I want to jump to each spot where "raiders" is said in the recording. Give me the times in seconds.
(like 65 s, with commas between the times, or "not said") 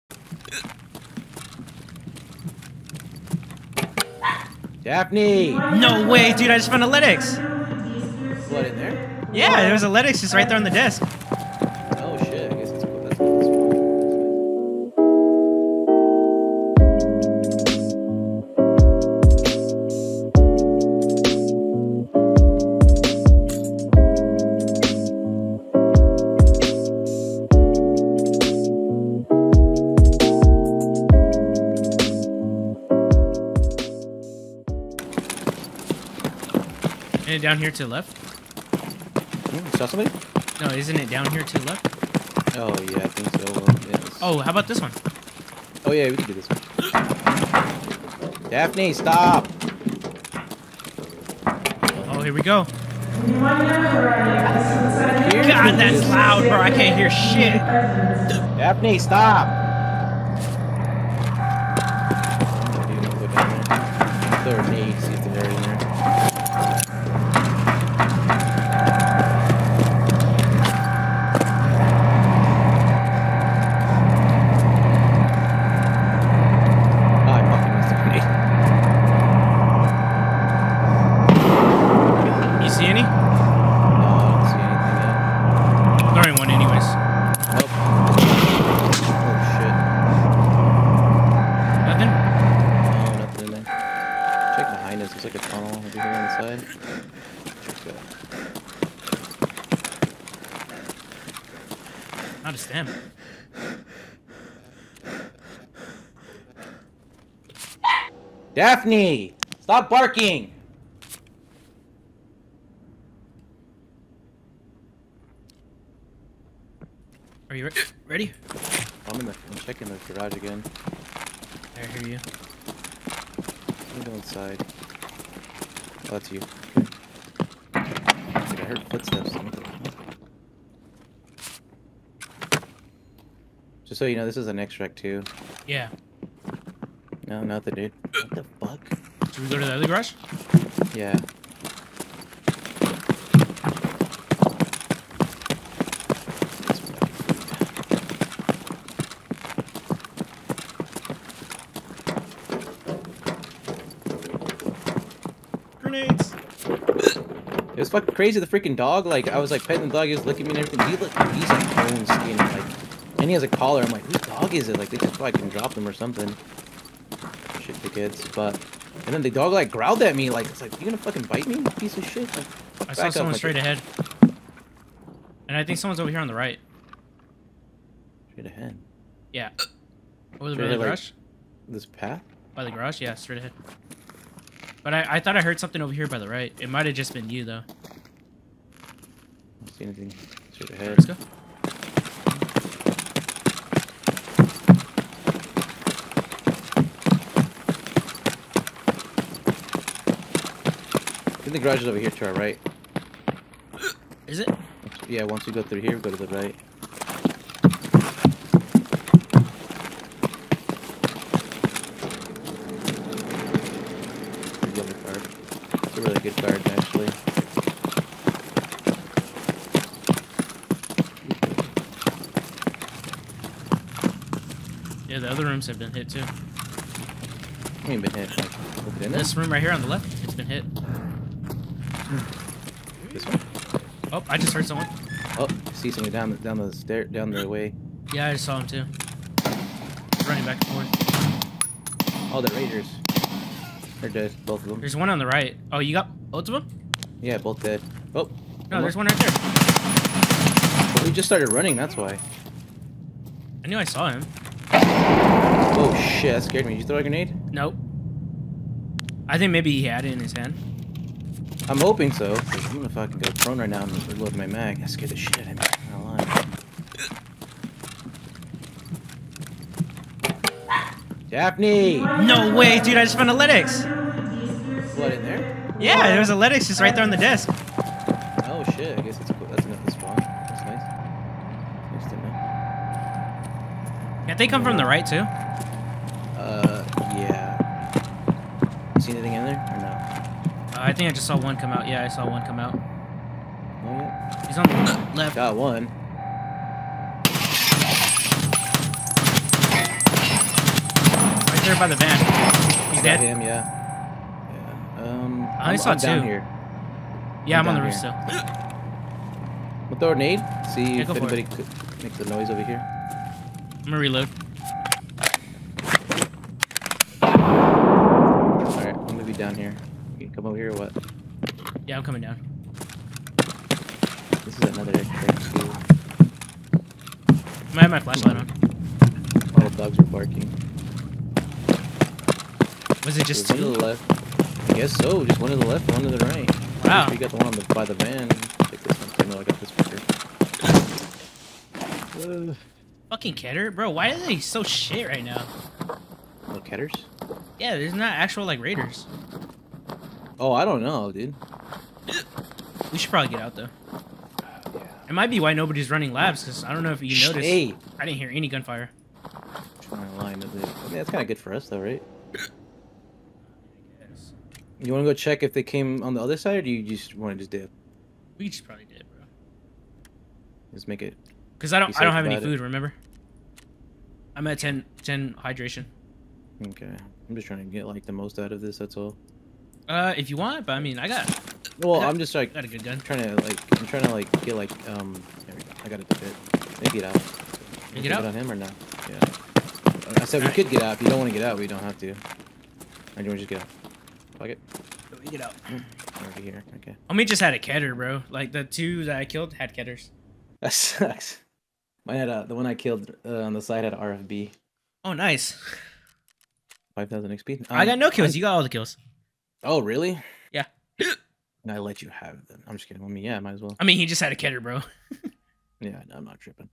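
242 s, 348 s.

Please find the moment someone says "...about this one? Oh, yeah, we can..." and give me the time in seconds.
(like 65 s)
44 s.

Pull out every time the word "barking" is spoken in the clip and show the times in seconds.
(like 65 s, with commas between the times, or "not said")
109 s, 330 s.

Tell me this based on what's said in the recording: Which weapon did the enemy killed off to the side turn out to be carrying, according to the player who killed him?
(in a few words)
RFB.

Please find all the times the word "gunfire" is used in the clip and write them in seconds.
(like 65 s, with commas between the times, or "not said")
358 s.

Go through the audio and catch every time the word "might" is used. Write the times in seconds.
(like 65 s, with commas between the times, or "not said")
186 s, 327 s, 355 s, 413 s.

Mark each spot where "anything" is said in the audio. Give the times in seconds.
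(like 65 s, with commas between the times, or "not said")
189 s, 289 s.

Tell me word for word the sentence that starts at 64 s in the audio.
Third knee, see if they're in there.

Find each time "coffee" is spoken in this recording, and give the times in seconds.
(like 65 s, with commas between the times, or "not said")
not said.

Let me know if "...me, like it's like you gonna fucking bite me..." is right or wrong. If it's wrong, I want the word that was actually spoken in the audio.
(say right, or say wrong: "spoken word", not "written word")
right.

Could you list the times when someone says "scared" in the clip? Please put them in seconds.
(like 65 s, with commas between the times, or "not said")
256 s, 264 s.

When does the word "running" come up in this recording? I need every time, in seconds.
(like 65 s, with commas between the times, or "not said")
240 s, 251 s, 355 s.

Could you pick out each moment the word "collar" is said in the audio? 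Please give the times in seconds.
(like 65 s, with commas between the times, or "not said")
163 s.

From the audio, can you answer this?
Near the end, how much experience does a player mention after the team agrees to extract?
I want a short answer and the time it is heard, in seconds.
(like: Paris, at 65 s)
5000 XP, at 406 s.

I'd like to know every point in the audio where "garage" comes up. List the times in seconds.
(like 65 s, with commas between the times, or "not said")
120 s, 139 s, 182 s, 201 s.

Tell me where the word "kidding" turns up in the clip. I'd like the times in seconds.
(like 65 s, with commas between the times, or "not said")
412 s.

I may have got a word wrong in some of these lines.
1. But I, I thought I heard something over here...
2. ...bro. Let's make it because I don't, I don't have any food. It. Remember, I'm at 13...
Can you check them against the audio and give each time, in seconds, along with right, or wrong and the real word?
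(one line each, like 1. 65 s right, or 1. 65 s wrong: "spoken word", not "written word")
1. 184 s right
2. 369 s wrong: "10", not "13".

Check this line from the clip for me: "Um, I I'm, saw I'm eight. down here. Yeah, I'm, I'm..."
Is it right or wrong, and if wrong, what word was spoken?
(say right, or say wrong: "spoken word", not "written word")
wrong: "two", not "eight".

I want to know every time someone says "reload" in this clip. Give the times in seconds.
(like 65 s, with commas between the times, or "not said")
264 s, 313 s.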